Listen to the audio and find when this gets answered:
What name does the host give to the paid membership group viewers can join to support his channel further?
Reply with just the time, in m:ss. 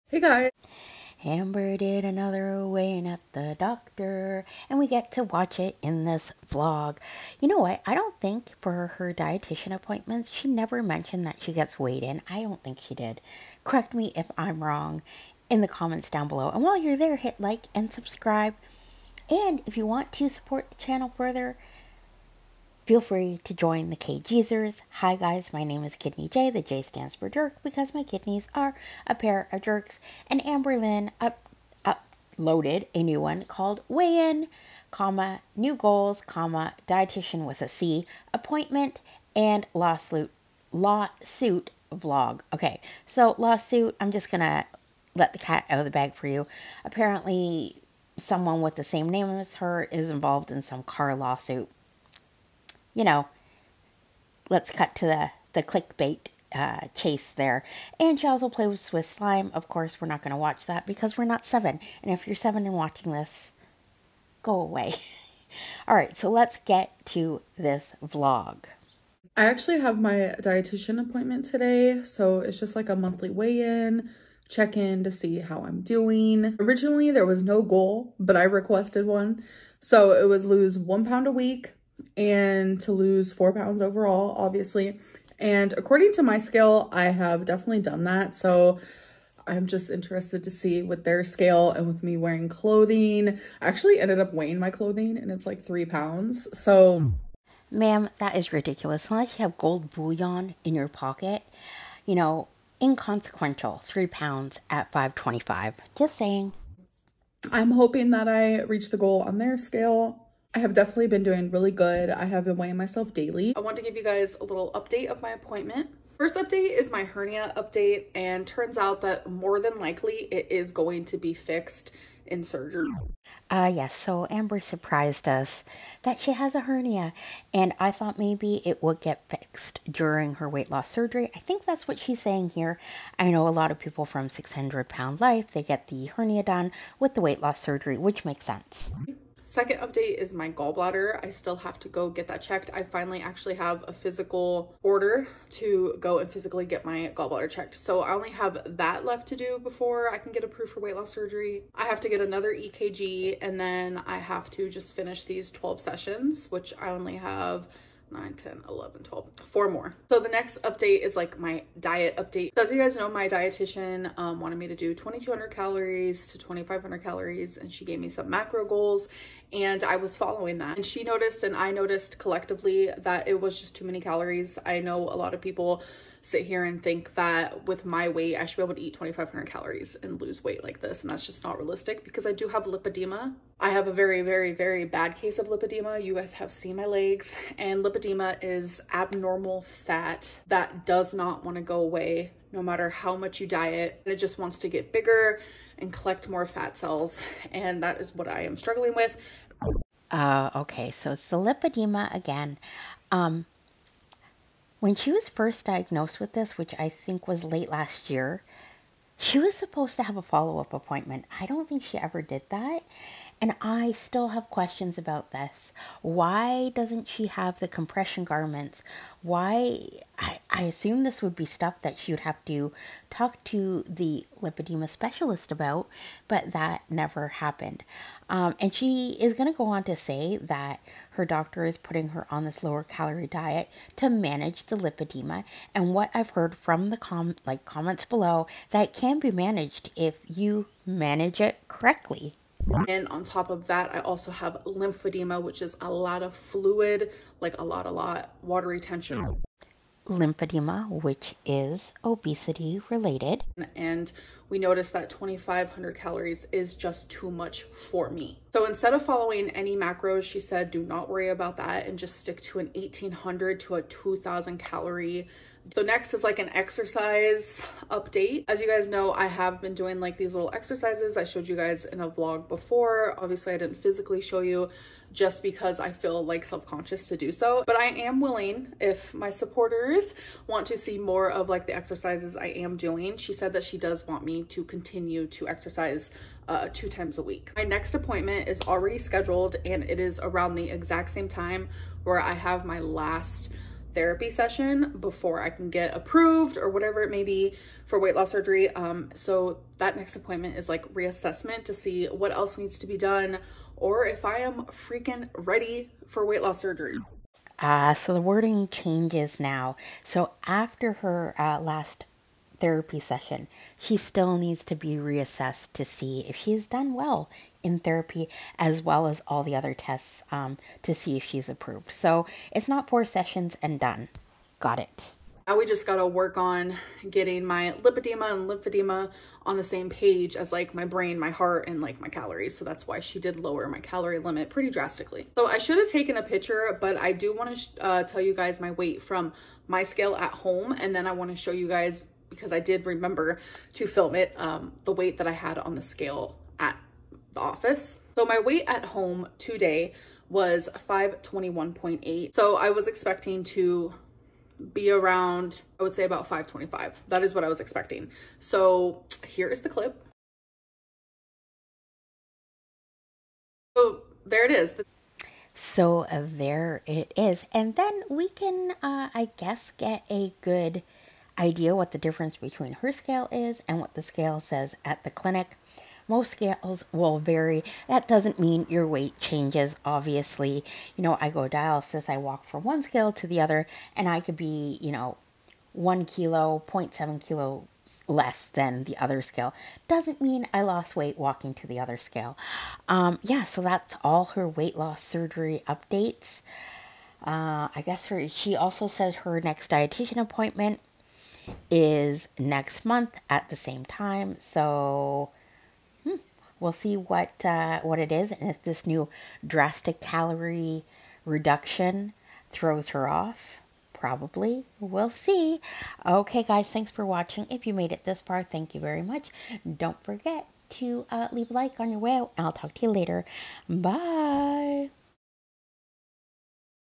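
0:23.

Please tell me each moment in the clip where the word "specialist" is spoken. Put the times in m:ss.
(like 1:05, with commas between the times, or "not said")
3:44.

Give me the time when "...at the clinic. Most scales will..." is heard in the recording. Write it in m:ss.
6:14.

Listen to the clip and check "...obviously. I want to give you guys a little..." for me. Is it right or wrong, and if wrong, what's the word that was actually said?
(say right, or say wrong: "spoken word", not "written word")
wrong: "daily", not "obviously".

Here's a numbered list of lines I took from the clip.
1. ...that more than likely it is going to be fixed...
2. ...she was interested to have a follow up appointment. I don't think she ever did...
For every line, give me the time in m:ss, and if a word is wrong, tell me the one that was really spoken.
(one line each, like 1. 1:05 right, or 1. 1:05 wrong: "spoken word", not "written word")
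1. 1:59 right
2. 3:29 wrong: "supposed", not "interested".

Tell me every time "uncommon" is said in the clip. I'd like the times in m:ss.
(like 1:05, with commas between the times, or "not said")
not said.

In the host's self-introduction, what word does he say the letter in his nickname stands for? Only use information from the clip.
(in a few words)
jerk.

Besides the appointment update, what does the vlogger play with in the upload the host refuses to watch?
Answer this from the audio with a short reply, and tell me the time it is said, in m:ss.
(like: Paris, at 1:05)
slime, at 0:59.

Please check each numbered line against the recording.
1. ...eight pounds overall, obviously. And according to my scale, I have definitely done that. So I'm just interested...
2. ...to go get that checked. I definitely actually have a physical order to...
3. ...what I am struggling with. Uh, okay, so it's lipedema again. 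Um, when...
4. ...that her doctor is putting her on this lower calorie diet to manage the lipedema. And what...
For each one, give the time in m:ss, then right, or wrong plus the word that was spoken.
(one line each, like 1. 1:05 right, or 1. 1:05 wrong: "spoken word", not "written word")
1. 1:23 wrong: "four", not "eight"
2. 2:21 wrong: "finally", not "definitely"
3. 3:18 right
4. 3:50 right.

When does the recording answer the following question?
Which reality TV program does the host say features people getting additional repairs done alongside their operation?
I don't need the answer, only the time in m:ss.
2:14.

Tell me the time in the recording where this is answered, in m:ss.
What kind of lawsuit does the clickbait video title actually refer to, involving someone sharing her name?
0:50.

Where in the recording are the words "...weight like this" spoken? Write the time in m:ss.
3:00.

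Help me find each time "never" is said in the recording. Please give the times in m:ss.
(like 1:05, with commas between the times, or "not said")
0:10, 3:46.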